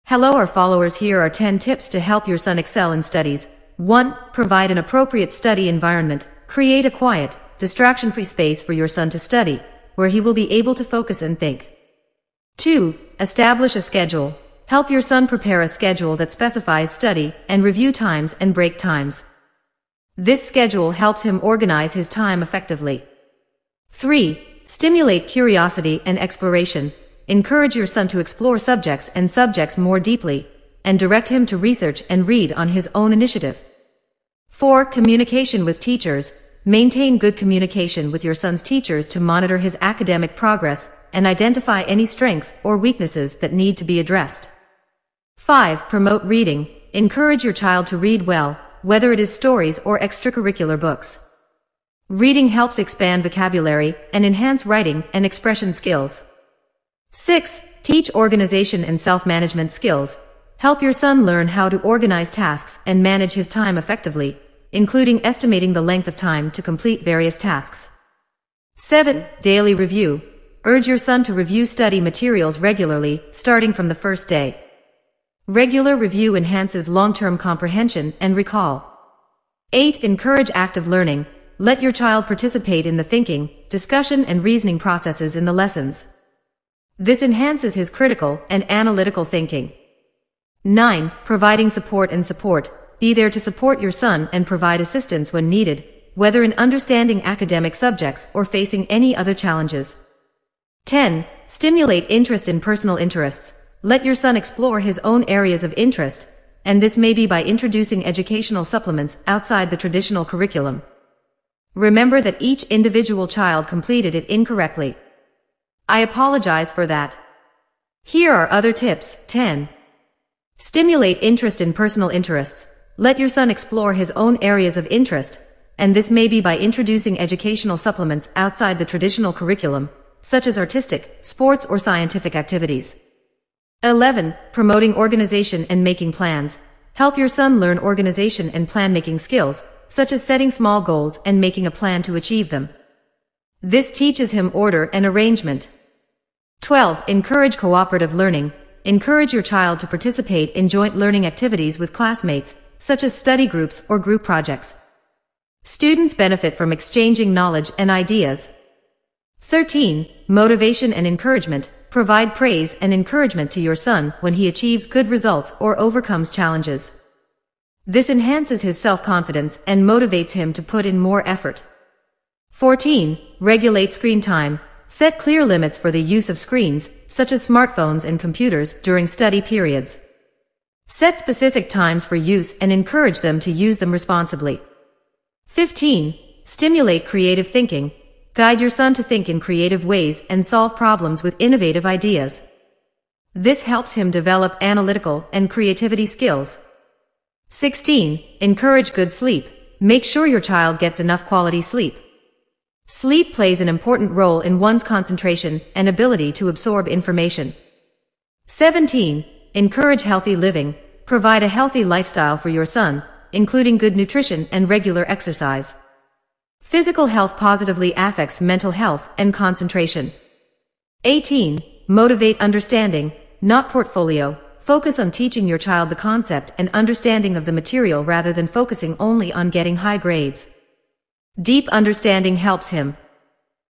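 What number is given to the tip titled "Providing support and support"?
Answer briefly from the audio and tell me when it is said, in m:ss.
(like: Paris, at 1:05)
9, at 1:30.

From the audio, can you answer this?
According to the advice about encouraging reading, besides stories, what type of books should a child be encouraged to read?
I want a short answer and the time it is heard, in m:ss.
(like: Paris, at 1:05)
Extracurricular books, at 0:49.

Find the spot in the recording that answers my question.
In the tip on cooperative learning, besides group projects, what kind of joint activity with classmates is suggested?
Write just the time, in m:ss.
2:33.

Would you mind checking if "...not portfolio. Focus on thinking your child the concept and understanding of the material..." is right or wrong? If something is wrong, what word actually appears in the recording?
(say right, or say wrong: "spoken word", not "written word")
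wrong: "teaching", not "thinking".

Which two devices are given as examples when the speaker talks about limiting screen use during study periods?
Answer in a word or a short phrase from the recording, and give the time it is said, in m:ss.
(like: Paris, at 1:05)
Smartphones and computers, at 2:57.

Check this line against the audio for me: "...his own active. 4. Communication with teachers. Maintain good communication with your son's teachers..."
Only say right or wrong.
wrong.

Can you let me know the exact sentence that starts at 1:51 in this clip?
Remember that each individual child completed it incorrectly.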